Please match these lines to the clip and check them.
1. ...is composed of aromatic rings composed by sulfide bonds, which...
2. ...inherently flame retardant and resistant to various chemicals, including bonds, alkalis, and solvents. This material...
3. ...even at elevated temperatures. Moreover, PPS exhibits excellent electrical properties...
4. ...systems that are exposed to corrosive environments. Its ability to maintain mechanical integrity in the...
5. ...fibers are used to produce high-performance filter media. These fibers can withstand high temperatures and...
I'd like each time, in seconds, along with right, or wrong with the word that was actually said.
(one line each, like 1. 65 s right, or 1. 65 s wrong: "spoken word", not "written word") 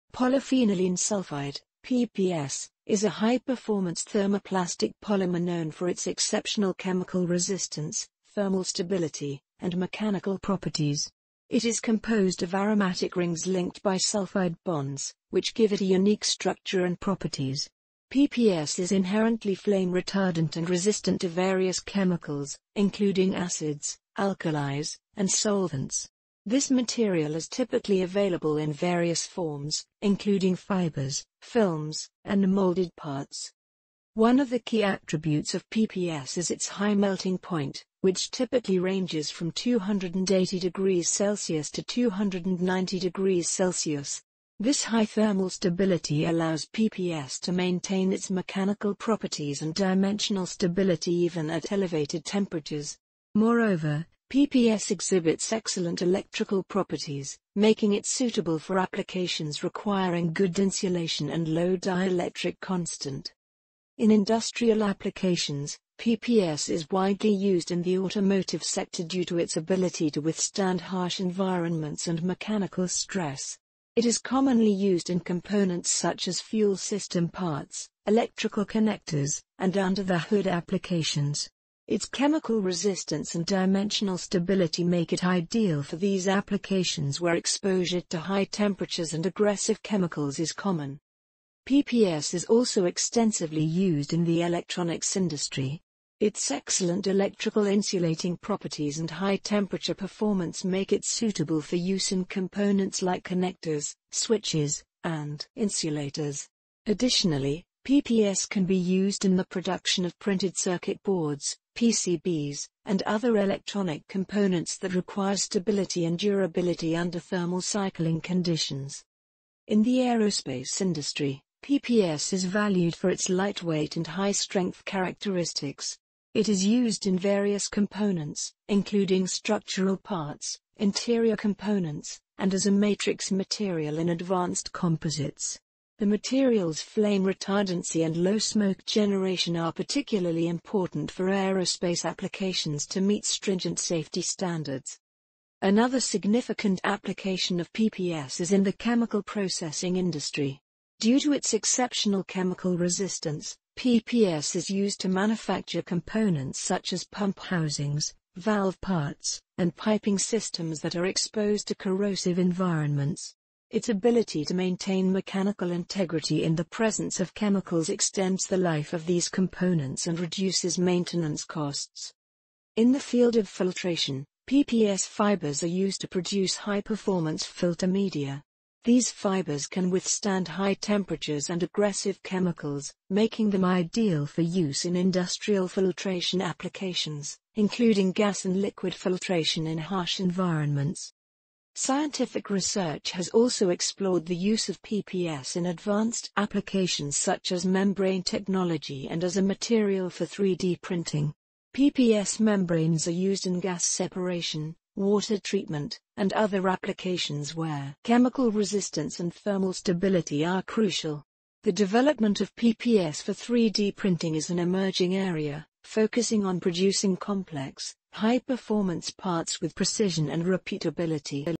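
1. 11 s wrong: "linked", not "composed"
2. 18 s wrong: "acids", not "bonds"
3. 51 s right
4. 160 s right
5. 175 s right.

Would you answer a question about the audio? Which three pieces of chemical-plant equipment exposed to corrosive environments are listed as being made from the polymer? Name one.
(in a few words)
Pump housings.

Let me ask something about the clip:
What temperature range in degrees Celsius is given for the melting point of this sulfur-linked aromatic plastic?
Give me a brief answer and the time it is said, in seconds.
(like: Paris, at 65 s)
280 to 290, at 39 s.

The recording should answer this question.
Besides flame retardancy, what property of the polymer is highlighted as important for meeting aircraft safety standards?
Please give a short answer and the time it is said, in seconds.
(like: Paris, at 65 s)
Low smoke generation, at 138 s.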